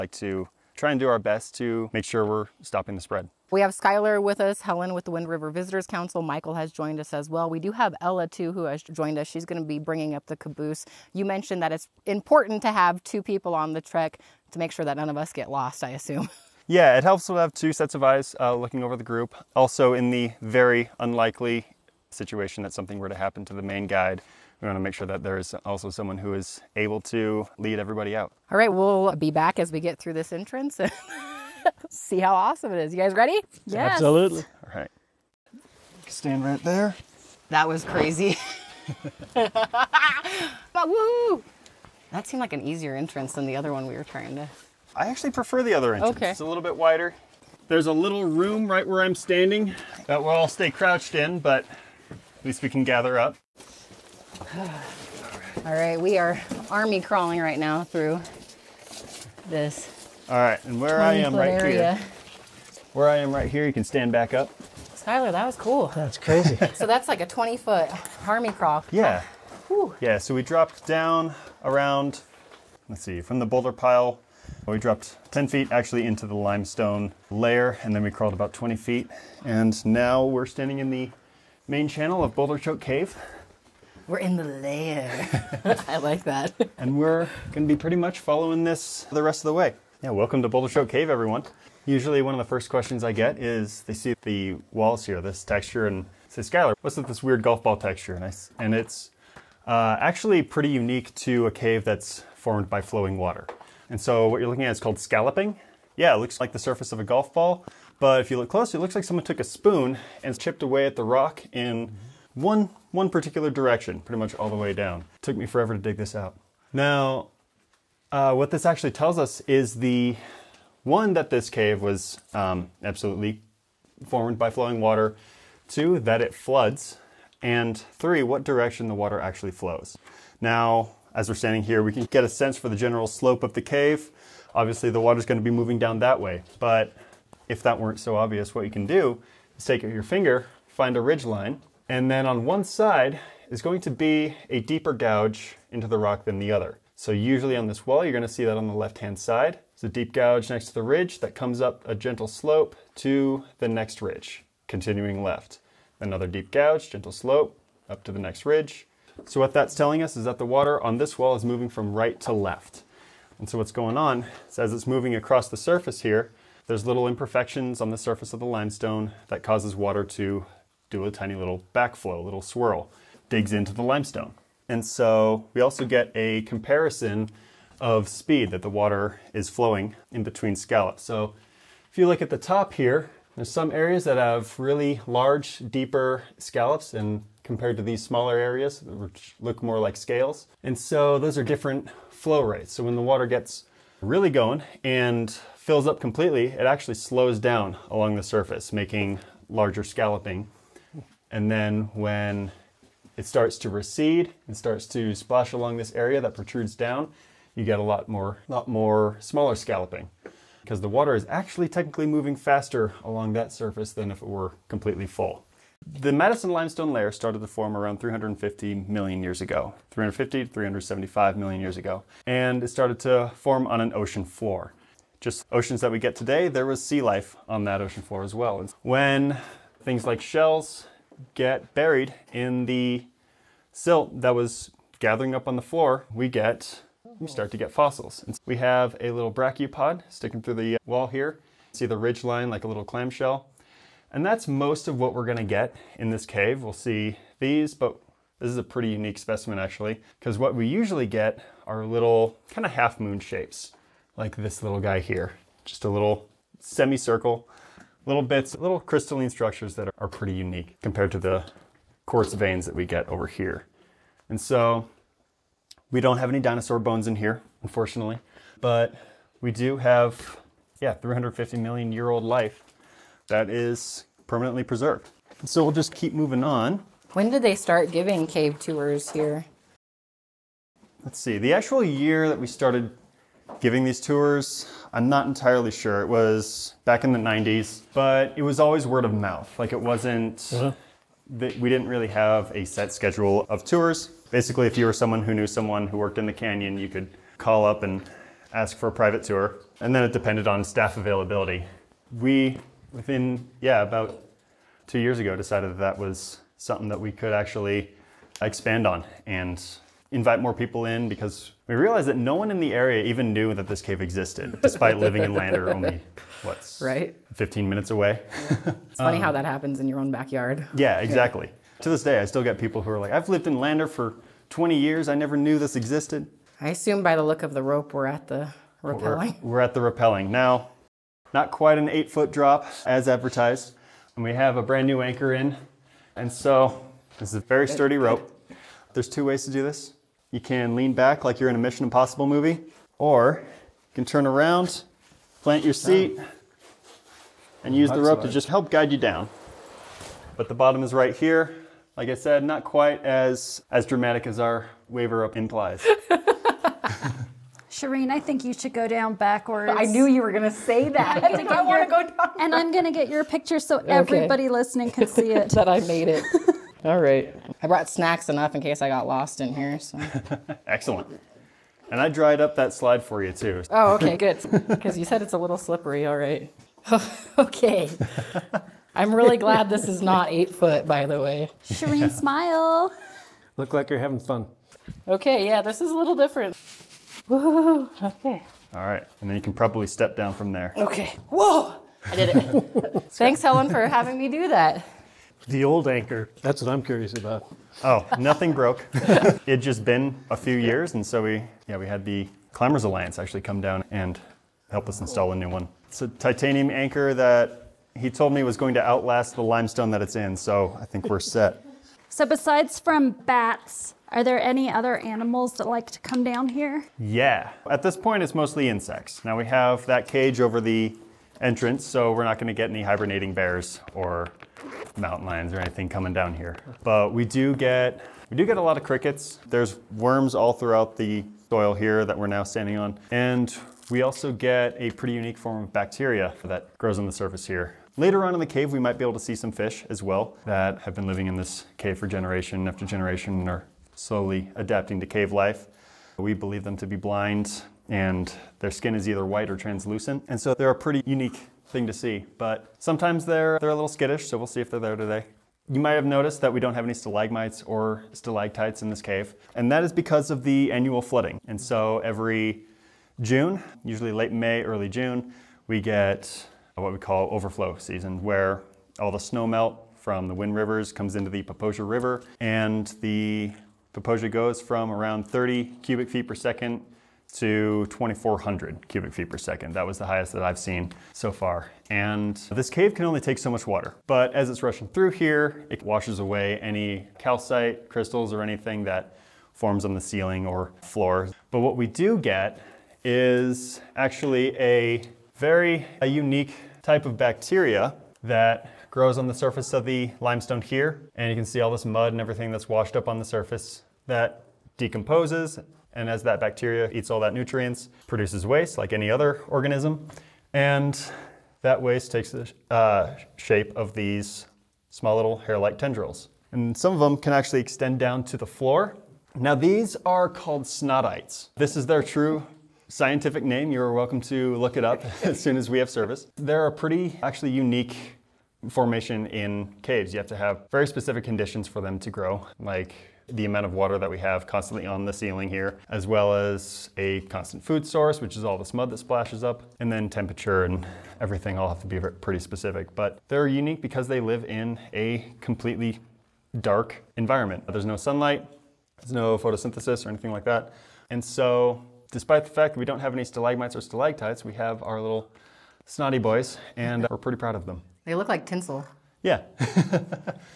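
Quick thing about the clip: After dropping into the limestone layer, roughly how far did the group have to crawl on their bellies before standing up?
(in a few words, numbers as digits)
20 feet.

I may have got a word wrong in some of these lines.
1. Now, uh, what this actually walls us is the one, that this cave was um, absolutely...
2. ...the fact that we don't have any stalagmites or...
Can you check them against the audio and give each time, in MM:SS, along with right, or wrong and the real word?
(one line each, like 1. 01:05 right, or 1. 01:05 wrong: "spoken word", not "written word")
1. 01:56 wrong: "tells", not "walls"
2. 09:12 right.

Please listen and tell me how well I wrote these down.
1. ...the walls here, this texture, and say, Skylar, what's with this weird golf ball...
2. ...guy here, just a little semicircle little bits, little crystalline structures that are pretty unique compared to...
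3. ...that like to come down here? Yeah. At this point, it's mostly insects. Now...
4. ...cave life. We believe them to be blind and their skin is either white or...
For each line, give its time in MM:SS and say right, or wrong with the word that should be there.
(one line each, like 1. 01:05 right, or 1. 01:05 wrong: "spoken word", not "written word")
1. 01:34 right
2. 04:14 right
3. 06:55 right
4. 07:25 right.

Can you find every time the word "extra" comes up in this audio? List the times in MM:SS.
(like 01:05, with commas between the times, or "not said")
not said.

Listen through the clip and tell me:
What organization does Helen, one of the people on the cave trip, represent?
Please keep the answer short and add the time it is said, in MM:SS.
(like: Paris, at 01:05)
Wind River Visitors Council, at 00:05.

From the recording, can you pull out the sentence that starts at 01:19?
And now we're standing in the main channel of Boulder Choke Cave.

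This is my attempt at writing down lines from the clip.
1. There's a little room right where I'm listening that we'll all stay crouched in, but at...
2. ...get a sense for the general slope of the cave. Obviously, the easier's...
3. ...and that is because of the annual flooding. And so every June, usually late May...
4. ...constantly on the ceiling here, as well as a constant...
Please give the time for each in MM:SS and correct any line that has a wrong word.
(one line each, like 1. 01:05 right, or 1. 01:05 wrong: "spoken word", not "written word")
1. 00:47 wrong: "standing", not "listening"
2. 02:12 wrong: "water", not "easier"
3. 07:39 right
4. 08:54 right.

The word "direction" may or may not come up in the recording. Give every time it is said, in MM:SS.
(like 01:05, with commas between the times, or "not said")
01:53, 02:08.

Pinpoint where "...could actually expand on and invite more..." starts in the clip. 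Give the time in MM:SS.
05:07.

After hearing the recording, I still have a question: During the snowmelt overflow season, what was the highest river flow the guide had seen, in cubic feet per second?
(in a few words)
2,400.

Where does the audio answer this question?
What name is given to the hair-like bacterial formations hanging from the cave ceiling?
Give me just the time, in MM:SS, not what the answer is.
08:40.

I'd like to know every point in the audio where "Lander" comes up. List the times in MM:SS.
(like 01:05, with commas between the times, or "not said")
05:15, 05:23.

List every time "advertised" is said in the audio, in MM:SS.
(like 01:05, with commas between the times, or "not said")
05:33.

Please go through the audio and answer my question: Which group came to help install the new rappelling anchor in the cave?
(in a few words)
Climbers Alliance.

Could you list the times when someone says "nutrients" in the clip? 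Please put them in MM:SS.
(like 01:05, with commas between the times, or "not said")
08:27.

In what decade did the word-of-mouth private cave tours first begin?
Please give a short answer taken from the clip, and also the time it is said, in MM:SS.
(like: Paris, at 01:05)
the 90s, at 04:47.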